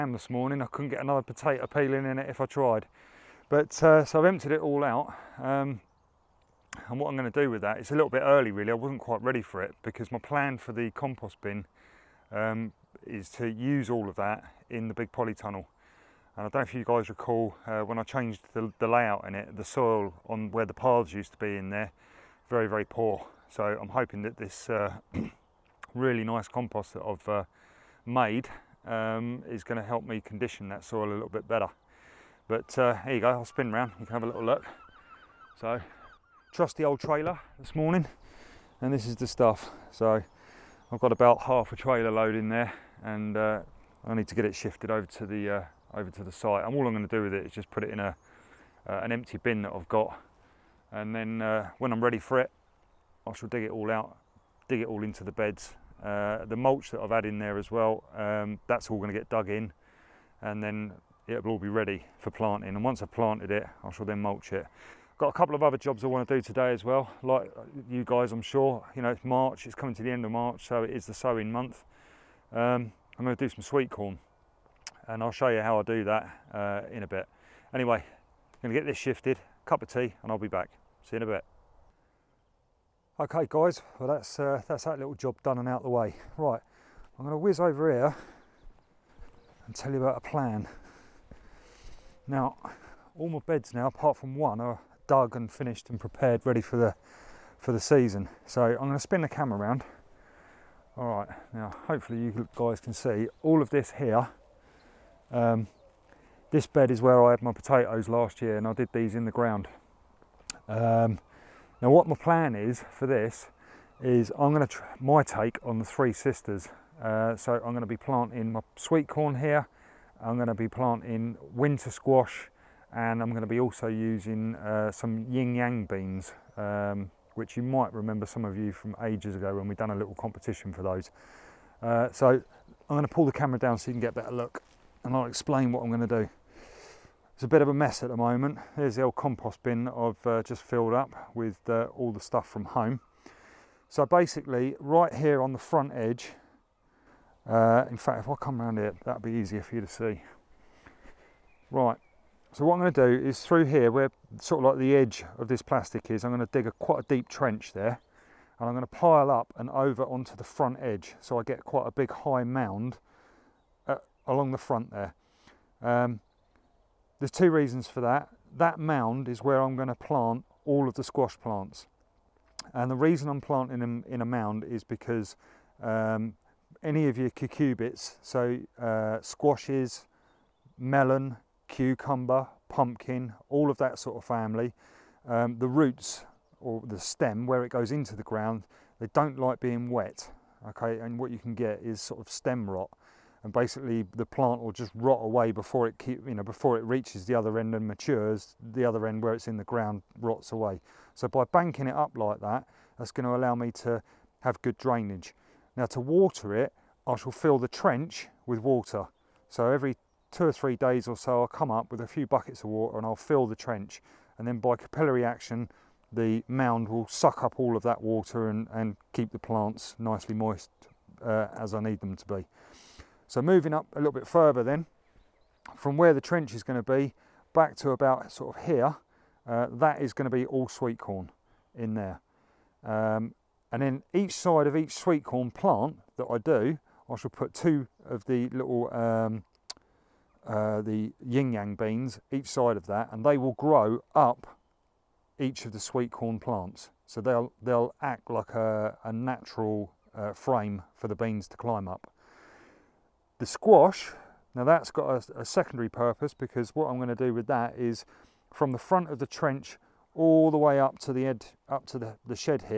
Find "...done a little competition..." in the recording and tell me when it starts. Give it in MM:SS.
02:09.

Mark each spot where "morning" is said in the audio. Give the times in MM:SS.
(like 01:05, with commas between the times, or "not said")
00:00, 00:37.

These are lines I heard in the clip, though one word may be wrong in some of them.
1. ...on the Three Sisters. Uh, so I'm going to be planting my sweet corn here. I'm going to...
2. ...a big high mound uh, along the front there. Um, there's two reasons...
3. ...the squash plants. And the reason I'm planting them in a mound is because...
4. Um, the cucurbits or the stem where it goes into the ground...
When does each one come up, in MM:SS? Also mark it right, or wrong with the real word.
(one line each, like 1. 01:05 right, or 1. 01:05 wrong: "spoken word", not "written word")
1. 01:55 right
2. 02:41 right
3. 02:50 right
4. 03:05 wrong: "roots", not "cucurbits".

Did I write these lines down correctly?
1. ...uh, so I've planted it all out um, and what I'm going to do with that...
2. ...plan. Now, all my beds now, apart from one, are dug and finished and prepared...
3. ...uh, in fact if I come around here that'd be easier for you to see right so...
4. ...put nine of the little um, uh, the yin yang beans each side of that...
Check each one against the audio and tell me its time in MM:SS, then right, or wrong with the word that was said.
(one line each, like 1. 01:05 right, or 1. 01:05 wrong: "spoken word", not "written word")
1. 00:03 wrong: "emptied", not "planted"
2. 01:30 right
3. 02:27 right
4. 03:57 wrong: "two", not "nine".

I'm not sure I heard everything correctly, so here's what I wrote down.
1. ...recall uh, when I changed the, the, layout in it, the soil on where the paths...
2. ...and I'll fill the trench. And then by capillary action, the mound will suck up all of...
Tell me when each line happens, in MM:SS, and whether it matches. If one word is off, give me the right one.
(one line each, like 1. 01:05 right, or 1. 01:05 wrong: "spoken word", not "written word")
1. 00:17 right
2. 03:32 right.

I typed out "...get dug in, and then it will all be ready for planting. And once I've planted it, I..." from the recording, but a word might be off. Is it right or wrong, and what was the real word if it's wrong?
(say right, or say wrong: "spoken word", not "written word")
right.